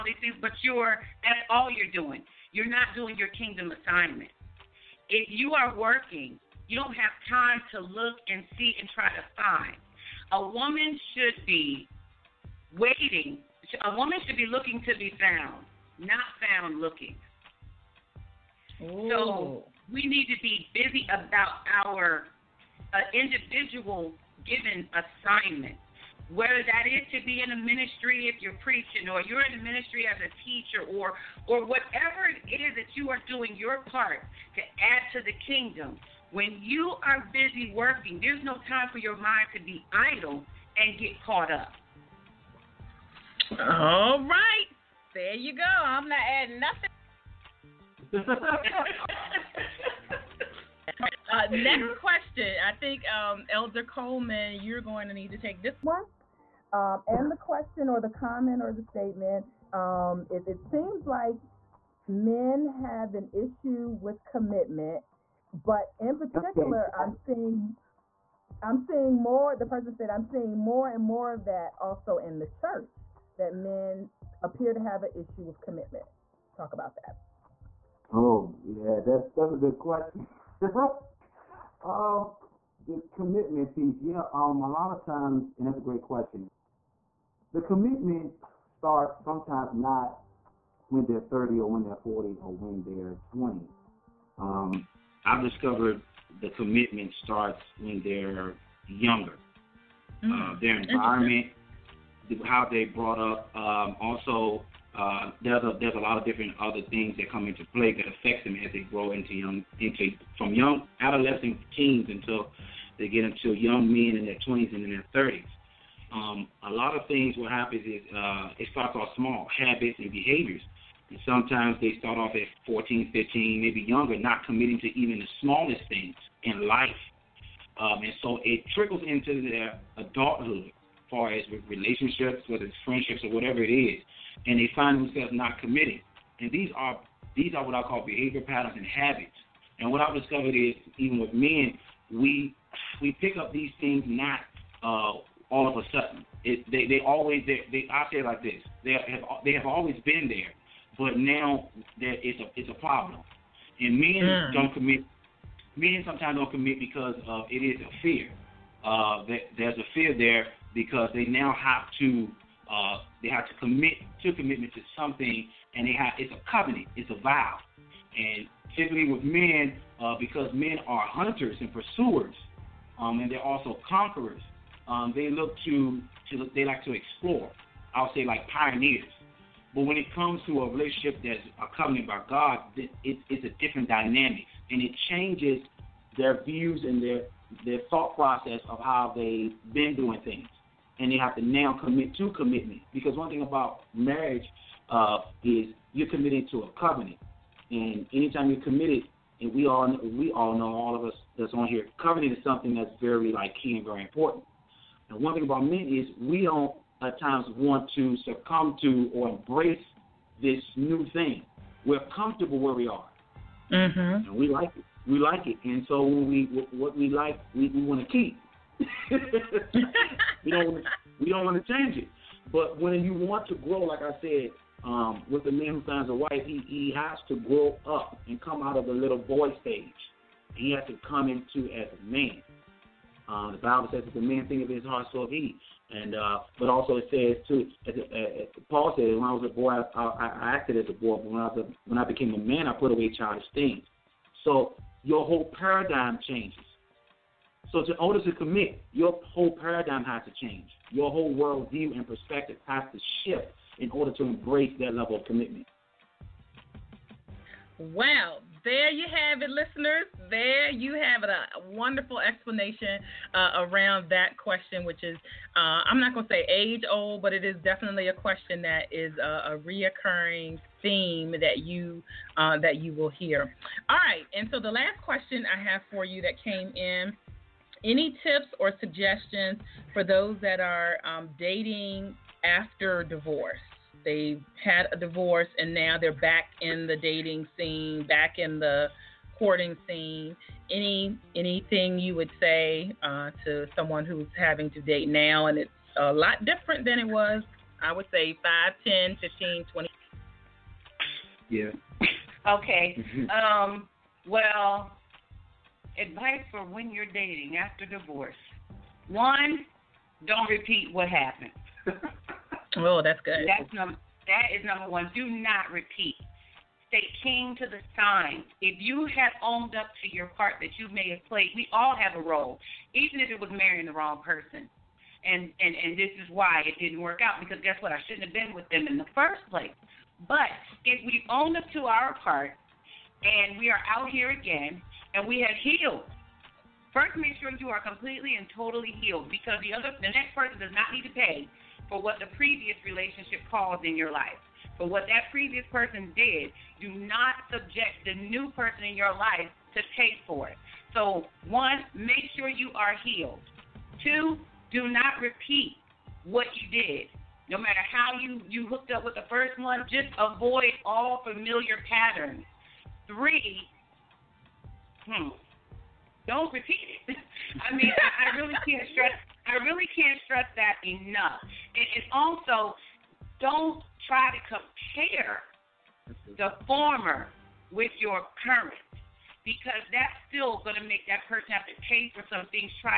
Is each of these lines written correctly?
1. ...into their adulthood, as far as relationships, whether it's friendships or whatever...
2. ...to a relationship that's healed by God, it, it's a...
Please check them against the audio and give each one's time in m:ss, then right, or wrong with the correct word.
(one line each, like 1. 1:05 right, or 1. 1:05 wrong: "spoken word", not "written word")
1. 2:09 right
2. 3:00 wrong: "accompanied", not "healed".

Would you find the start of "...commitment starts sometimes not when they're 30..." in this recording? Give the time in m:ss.
1:27.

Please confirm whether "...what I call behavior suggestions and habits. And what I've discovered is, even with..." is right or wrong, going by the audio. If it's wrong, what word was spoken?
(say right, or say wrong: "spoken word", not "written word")
wrong: "patterns", not "suggestions".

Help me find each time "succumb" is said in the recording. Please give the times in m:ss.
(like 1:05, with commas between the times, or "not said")
3:28.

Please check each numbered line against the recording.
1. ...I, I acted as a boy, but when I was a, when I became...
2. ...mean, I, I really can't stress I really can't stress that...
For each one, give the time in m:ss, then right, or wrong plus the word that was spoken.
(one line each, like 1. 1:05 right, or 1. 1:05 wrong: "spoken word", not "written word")
1. 3:59 right
2. 6:07 right.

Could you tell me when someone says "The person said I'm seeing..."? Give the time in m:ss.
1:09.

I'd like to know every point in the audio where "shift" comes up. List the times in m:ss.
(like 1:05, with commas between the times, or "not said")
4:13.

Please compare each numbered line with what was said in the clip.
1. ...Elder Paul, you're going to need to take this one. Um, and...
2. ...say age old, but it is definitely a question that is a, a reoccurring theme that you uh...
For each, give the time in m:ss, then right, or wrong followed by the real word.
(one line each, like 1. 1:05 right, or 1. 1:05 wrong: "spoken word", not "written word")
1. 0:53 wrong: "Coleman", not "Paul"
2. 4:26 right.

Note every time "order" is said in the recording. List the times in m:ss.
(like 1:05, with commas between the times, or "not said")
4:07, 4:13.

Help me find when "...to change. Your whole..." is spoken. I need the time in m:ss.
4:10.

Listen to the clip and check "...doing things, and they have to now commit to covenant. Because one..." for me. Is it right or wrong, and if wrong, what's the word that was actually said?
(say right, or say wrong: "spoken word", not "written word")
wrong: "commitment", not "covenant".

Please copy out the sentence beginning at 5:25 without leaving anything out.
And and and this is why it didn't work out because guess what?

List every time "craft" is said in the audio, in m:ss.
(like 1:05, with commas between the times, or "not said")
not said.